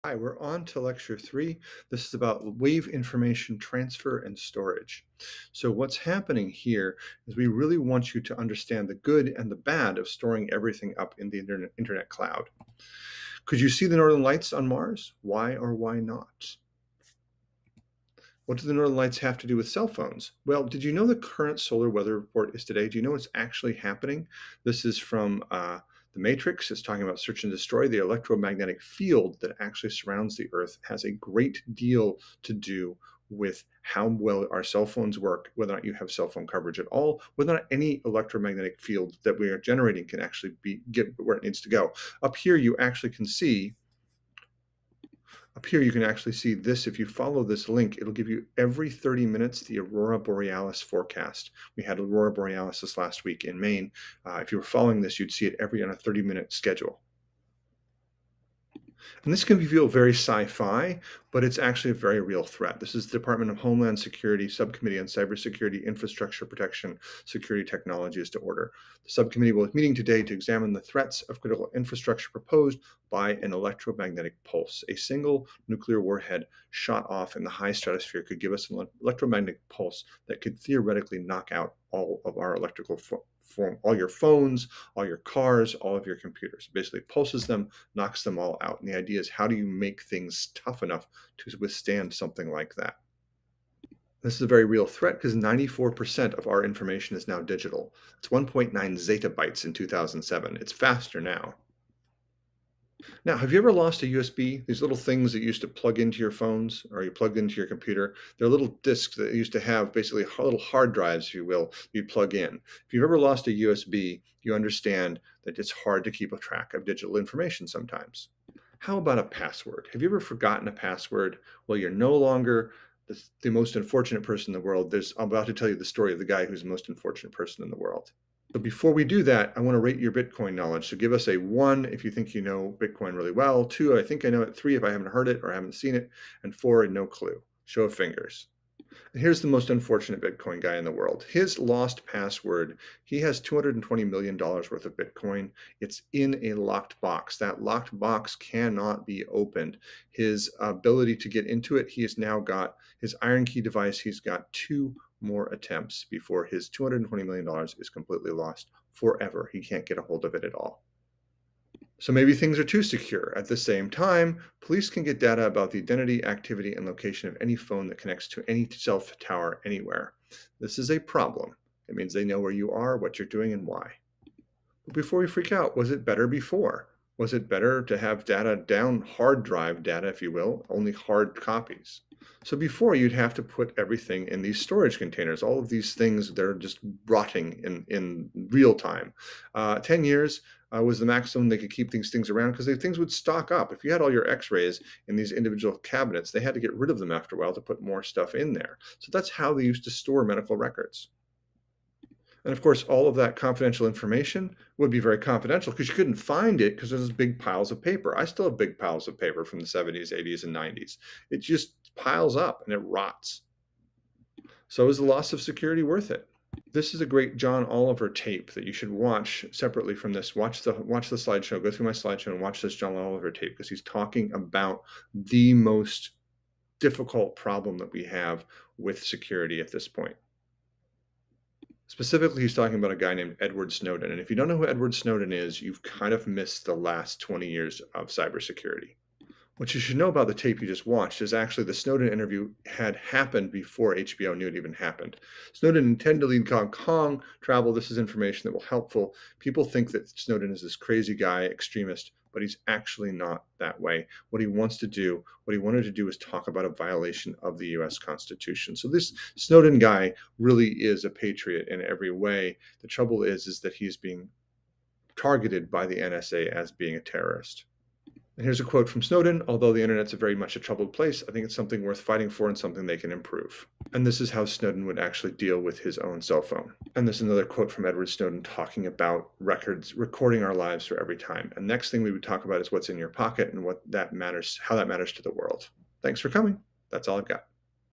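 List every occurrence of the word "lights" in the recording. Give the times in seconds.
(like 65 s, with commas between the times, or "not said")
14 s, 18 s.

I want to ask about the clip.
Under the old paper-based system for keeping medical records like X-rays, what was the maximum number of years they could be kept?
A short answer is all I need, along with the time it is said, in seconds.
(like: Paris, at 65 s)
10 years, at 189 s.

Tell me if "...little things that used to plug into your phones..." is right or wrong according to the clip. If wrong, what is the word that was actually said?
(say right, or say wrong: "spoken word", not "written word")
right.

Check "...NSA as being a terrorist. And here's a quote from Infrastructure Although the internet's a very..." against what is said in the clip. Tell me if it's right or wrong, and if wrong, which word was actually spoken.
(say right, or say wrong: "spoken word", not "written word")
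wrong: "Snowden", not "Infrastructure".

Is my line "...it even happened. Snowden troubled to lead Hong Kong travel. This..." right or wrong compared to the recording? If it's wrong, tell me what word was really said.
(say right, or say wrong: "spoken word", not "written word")
wrong: "intended", not "troubled".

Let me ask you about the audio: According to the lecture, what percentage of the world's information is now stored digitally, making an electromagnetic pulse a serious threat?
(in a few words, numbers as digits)
94%.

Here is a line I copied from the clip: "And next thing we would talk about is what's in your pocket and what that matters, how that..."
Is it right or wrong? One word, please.
right.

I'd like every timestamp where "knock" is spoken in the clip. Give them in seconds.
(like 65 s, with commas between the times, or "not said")
81 s, 87 s.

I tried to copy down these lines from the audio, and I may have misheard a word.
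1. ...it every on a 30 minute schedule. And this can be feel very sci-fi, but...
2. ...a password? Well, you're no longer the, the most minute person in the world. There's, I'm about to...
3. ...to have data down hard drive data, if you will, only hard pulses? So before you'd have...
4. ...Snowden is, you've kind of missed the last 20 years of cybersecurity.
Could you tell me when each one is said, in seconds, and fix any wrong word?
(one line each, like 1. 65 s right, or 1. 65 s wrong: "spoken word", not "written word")
1. 55 s right
2. 120 s wrong: "unfortunate", not "minute"
3. 177 s wrong: "copies", not "pulses"
4. 234 s right.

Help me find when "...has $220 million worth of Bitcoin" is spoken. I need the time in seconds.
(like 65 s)
143 s.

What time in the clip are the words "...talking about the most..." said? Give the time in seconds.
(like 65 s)
223 s.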